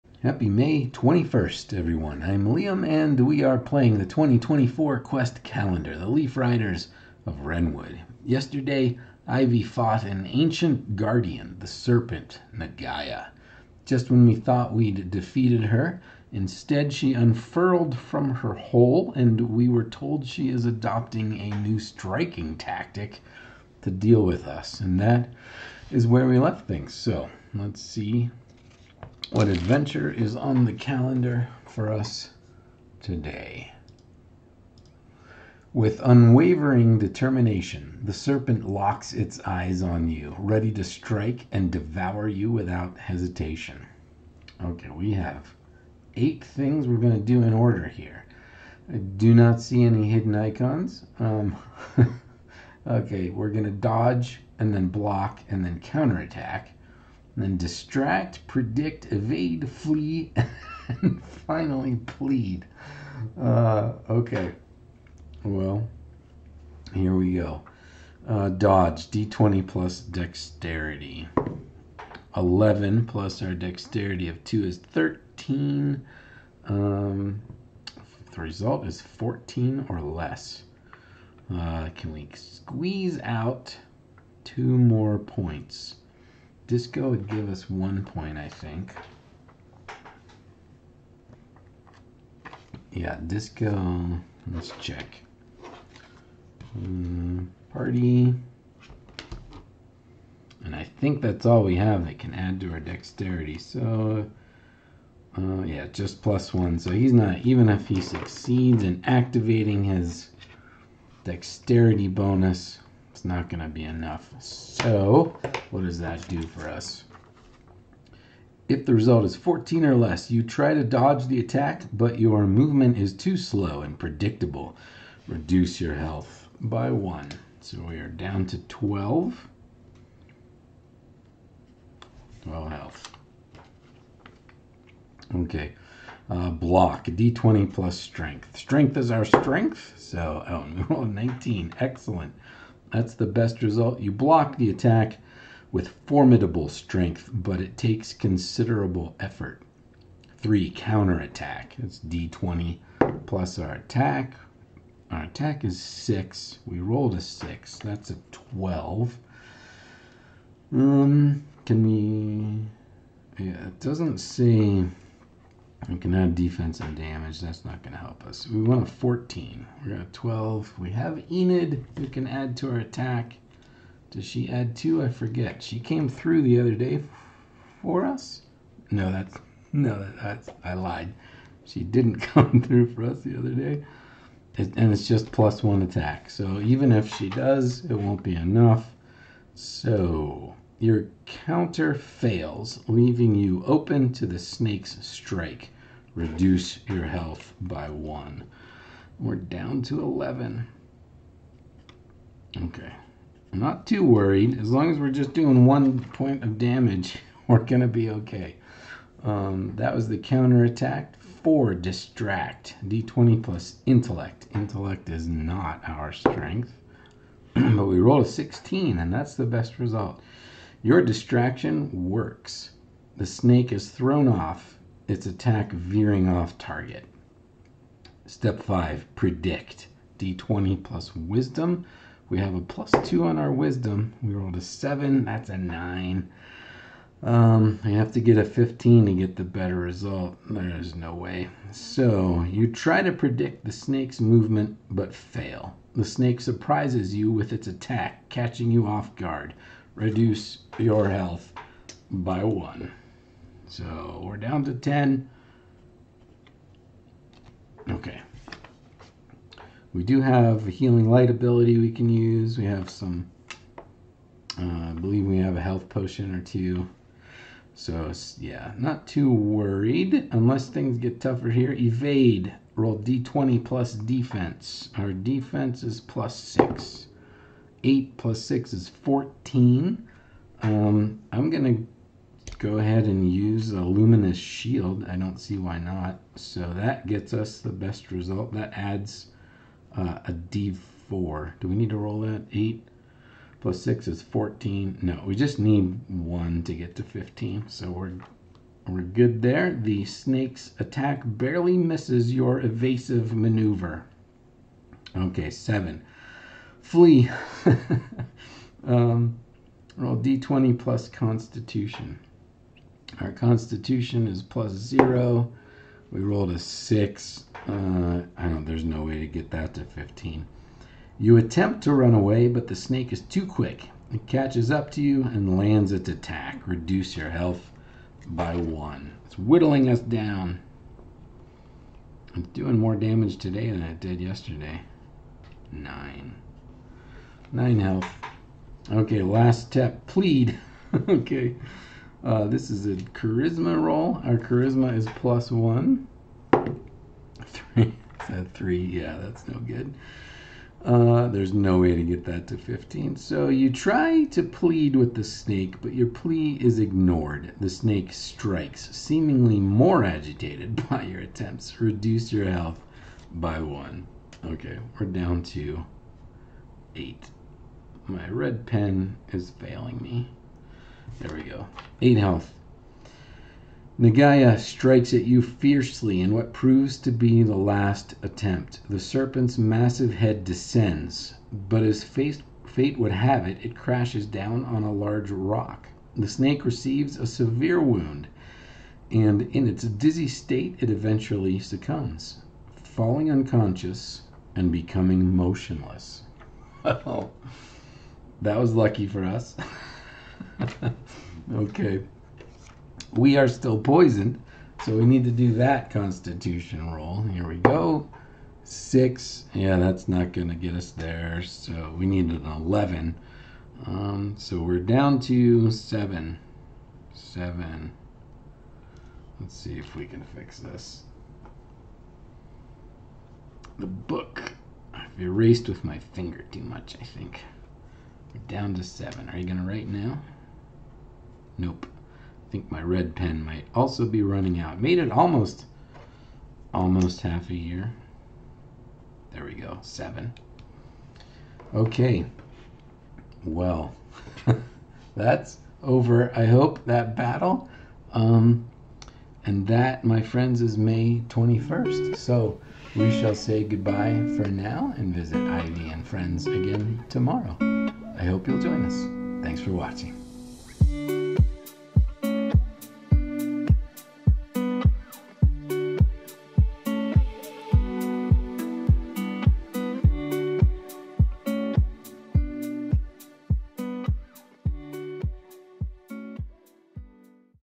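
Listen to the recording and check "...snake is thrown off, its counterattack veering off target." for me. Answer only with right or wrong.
wrong.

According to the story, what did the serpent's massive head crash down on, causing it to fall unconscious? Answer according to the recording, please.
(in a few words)
a large rock.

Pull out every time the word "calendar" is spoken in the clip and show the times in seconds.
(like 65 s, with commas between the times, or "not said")
5 s, 30 s.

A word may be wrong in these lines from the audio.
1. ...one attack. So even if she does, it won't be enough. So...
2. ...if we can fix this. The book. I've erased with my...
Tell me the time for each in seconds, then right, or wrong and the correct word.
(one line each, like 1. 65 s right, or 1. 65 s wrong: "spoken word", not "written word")
1. 185 s right
2. 419 s right.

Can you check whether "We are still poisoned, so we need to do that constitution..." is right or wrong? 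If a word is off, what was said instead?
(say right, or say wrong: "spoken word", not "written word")
right.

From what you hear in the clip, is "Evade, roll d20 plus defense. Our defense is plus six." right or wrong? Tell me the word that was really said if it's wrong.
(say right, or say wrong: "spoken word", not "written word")
right.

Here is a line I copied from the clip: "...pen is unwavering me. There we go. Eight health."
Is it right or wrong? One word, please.
wrong.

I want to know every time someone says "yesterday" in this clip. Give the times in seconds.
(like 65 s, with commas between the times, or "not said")
8 s, 334 s.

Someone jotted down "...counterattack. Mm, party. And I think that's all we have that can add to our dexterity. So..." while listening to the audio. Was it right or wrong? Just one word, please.
wrong.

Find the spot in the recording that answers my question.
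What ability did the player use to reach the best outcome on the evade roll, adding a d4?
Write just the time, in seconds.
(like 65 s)
283 s.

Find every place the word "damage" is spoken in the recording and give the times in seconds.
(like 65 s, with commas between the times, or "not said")
166 s, 206 s, 332 s.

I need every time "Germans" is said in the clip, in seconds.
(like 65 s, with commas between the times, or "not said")
not said.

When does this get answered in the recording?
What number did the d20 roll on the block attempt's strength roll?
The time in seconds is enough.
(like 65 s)
141 s.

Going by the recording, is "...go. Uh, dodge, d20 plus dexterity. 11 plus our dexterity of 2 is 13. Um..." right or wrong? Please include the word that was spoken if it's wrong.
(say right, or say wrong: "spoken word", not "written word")
right.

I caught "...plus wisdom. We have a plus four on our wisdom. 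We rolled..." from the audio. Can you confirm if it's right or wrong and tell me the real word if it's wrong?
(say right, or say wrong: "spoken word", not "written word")
wrong: "two", not "four".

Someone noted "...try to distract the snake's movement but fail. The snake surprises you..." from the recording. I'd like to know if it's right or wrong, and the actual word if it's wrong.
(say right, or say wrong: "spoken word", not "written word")
wrong: "predict", not "distract".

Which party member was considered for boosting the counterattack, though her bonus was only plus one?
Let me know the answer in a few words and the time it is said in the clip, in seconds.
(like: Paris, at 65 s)
Enid, at 171 s.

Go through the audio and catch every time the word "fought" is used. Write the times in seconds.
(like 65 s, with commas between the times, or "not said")
9 s.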